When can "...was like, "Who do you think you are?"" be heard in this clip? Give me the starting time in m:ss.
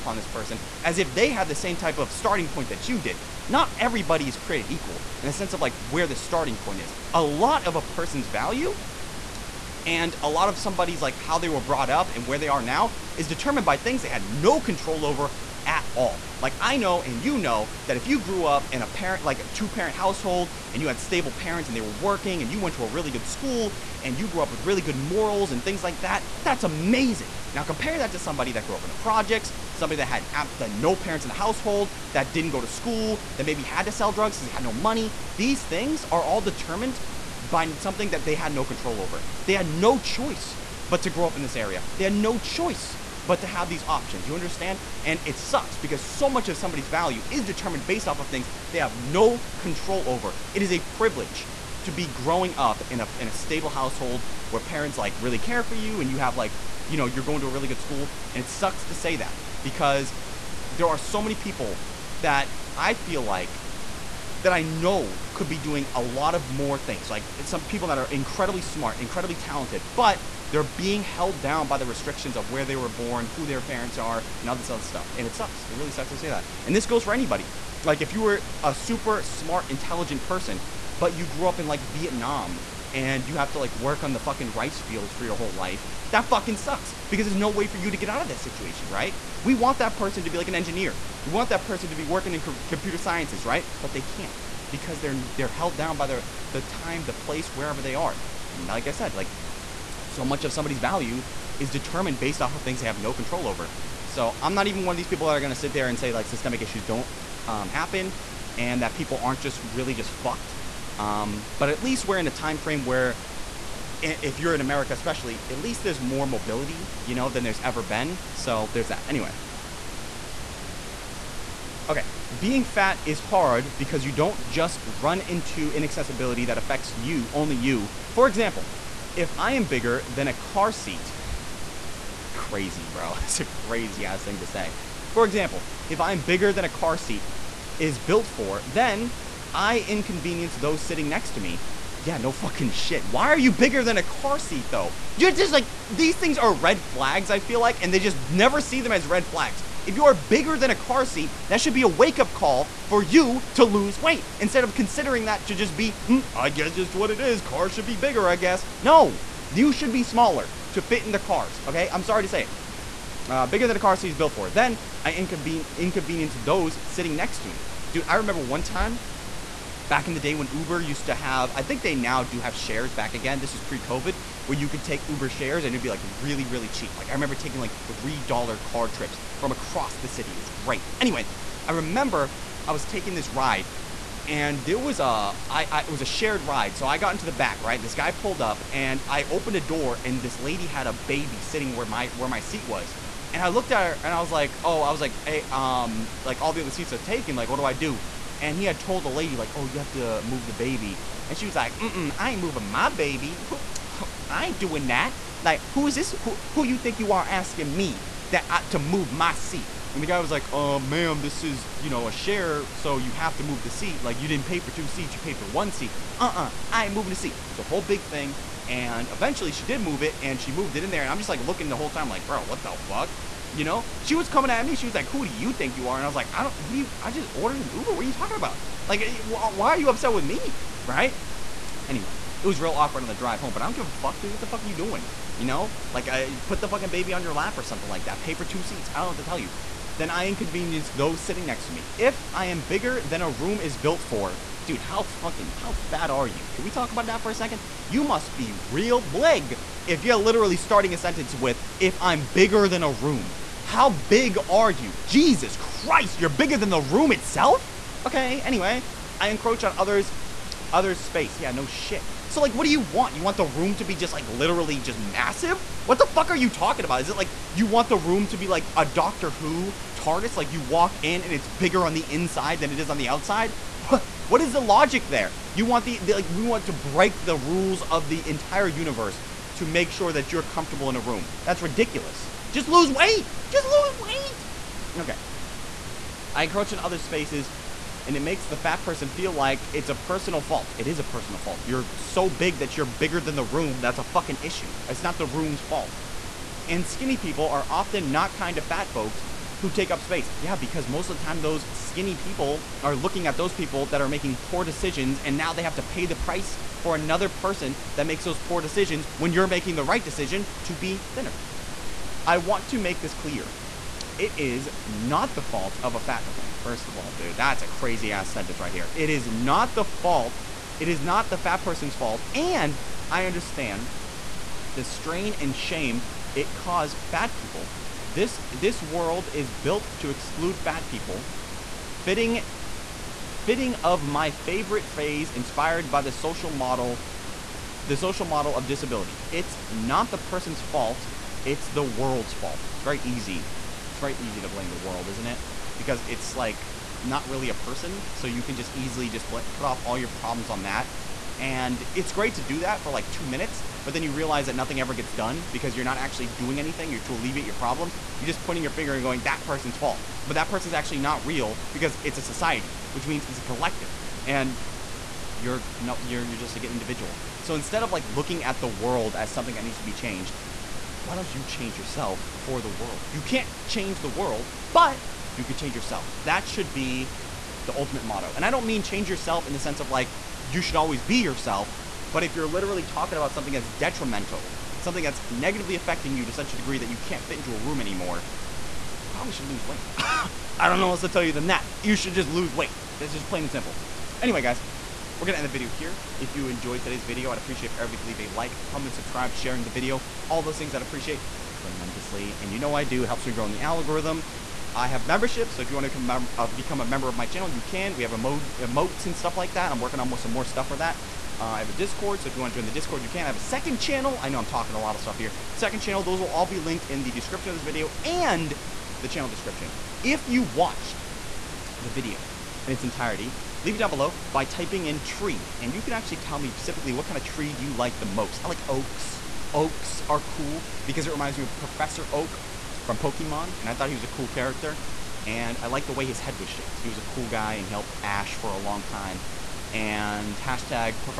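3:44.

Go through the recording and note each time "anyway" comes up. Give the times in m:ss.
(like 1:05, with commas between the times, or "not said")
1:59, 3:00, 3:51, 4:18, 6:34.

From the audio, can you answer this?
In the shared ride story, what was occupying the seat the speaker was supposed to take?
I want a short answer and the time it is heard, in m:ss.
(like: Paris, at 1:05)
a baby, at 3:10.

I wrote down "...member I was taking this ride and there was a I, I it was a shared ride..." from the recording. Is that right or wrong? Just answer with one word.
wrong.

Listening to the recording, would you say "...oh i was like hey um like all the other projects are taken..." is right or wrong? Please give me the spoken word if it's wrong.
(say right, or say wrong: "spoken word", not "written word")
wrong: "seats", not "projects".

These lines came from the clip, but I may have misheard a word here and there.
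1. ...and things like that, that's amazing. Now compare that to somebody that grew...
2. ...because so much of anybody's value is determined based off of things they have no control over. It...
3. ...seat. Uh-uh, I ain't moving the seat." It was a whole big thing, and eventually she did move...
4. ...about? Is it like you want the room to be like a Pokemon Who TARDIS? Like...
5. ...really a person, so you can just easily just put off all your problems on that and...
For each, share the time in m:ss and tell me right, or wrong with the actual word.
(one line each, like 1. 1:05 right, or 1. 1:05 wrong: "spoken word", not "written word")
1. 0:25 right
2. 0:45 wrong: "somebody", not "anybody"
3. 3:35 right
4. 4:26 wrong: "Doctor", not "Pokemon"
5. 5:47 right.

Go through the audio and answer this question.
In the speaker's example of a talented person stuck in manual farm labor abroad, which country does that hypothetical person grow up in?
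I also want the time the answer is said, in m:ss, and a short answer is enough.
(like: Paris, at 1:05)
Vietnam, at 1:21.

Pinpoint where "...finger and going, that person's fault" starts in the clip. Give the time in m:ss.
5:58.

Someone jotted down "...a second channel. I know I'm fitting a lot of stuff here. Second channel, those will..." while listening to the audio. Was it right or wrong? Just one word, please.
wrong.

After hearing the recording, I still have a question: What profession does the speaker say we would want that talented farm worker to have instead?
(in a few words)
engineer.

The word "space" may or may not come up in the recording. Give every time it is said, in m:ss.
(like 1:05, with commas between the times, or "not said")
4:21, 4:46, 5:00.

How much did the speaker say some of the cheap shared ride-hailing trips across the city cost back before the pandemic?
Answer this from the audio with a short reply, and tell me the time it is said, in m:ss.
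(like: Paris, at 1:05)
$3, at 2:57.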